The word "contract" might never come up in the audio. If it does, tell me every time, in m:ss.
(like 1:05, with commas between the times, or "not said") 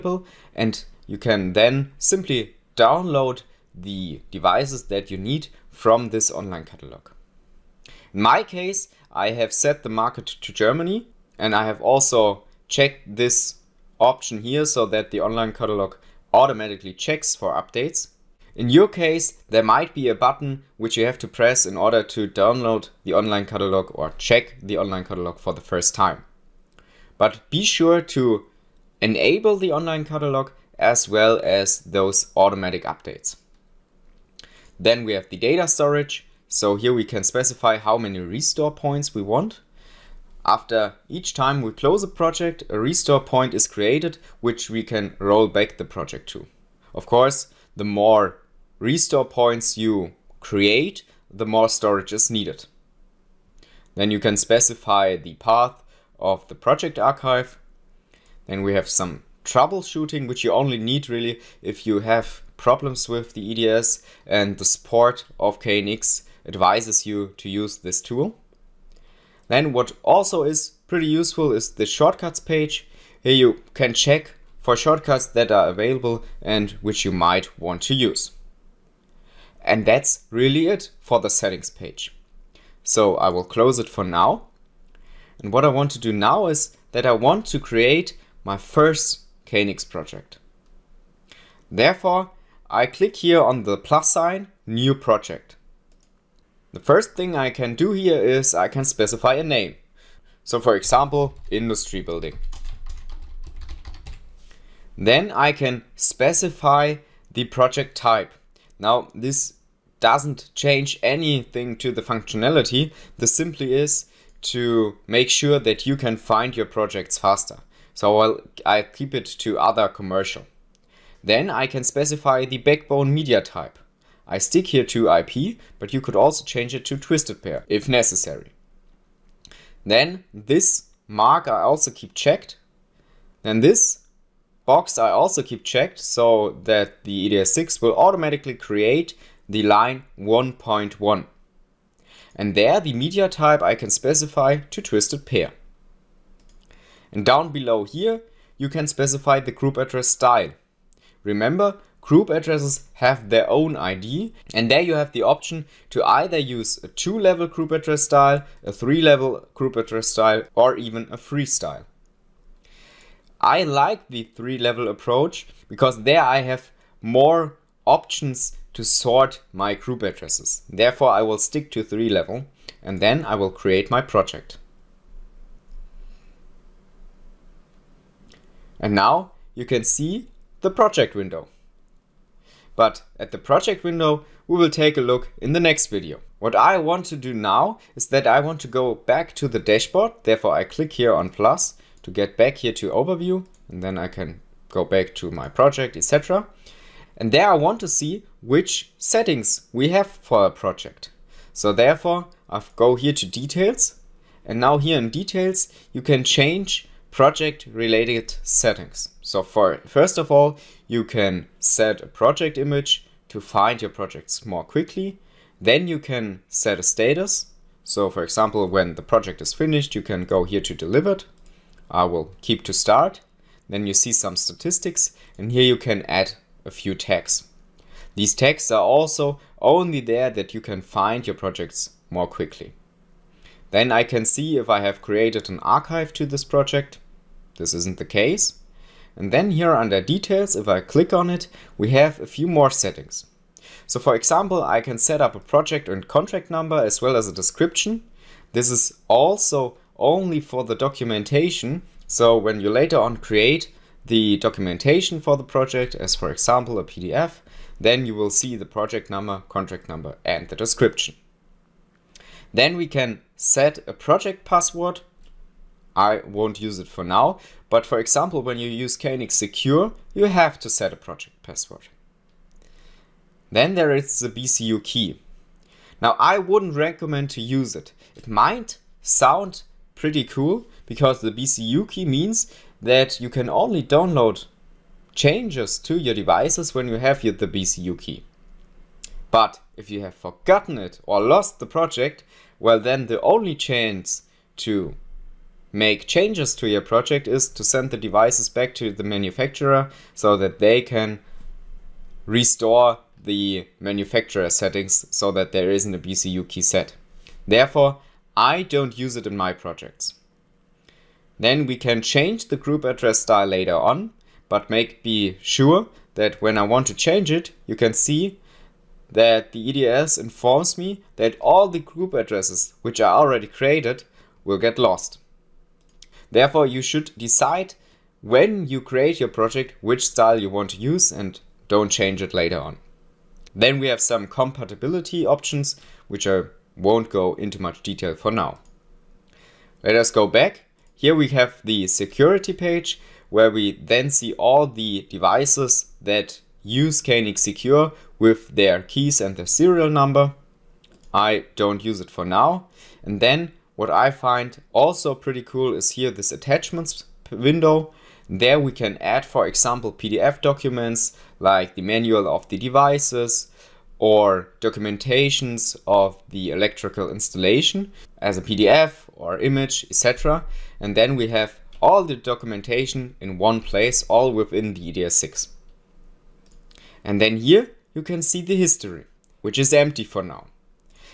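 4:06, 4:19.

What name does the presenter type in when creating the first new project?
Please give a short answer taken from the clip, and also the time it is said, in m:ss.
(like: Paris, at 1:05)
industry building, at 1:41.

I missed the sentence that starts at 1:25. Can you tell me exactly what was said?
And what I want to do now is that I want to create my first KNX project.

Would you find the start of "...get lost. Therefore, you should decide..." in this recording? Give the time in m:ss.
5:24.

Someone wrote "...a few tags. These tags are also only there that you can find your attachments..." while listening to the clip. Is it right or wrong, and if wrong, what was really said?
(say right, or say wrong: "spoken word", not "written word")
wrong: "projects", not "attachments".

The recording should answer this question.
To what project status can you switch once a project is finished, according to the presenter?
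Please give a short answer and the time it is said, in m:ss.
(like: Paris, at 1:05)
delivered, at 3:40.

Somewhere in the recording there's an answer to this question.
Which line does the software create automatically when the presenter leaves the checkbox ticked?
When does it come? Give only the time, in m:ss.
2:19.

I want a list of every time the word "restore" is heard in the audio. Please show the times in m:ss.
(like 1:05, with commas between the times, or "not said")
0:38, 0:42, 0:48, 5:02.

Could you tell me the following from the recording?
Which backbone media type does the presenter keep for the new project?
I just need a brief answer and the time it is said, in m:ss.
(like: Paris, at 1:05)
IP, at 2:05.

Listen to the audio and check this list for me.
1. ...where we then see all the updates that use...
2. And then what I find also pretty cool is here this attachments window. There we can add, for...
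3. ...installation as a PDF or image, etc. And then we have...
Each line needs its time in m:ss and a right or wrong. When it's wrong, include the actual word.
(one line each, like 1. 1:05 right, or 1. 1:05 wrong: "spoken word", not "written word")
1. 5:43 wrong: "devices", not "updates"
2. 5:53 right
3. 6:07 right.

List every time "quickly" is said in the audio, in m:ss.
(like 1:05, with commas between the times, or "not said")
3:34, 3:52.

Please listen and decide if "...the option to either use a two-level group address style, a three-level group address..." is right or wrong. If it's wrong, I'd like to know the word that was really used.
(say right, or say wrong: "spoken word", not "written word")
right.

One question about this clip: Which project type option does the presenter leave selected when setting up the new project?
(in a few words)
other commercial.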